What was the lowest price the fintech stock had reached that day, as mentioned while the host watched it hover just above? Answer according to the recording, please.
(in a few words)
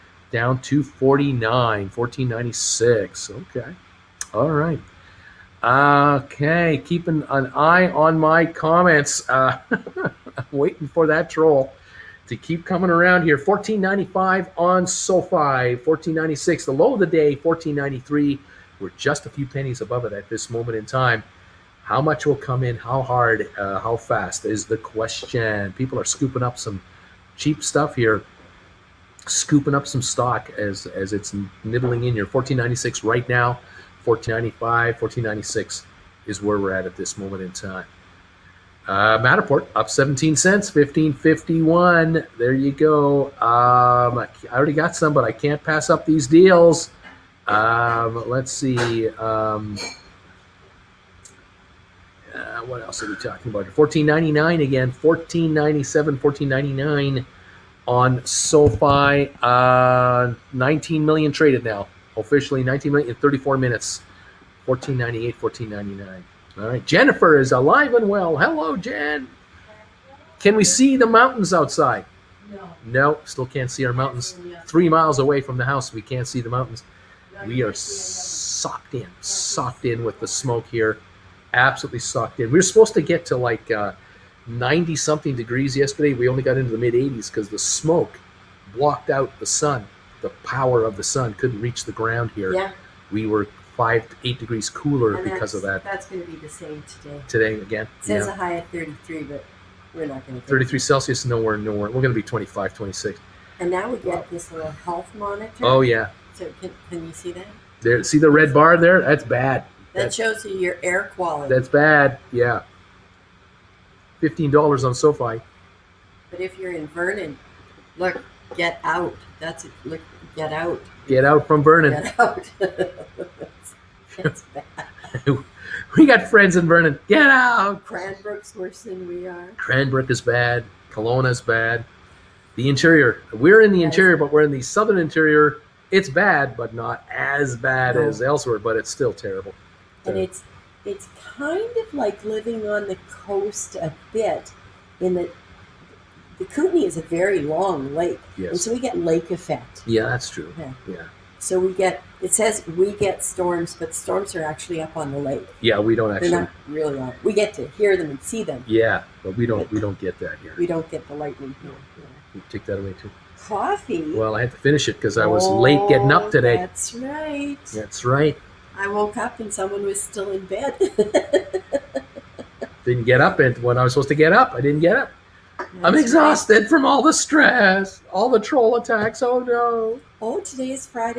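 14.93.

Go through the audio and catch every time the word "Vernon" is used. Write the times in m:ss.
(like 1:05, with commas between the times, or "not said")
1:56, 2:01, 2:06.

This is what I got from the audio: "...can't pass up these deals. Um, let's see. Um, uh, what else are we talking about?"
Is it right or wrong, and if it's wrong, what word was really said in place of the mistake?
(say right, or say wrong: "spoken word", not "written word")
right.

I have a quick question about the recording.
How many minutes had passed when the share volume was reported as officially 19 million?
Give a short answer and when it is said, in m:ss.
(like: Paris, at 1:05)
34, at 1:03.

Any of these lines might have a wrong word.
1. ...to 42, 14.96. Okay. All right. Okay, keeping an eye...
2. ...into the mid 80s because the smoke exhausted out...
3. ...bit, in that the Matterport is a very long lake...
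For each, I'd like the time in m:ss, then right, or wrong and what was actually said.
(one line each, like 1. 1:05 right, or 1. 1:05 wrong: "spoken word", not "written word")
1. 0:00 wrong: "49", not "42"
2. 1:26 wrong: "blocked", not "exhausted"
3. 2:24 wrong: "Kootenay", not "Matterport".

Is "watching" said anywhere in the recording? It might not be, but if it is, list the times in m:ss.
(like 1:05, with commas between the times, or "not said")
not said.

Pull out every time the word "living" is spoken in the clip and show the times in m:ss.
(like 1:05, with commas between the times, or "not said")
2:22.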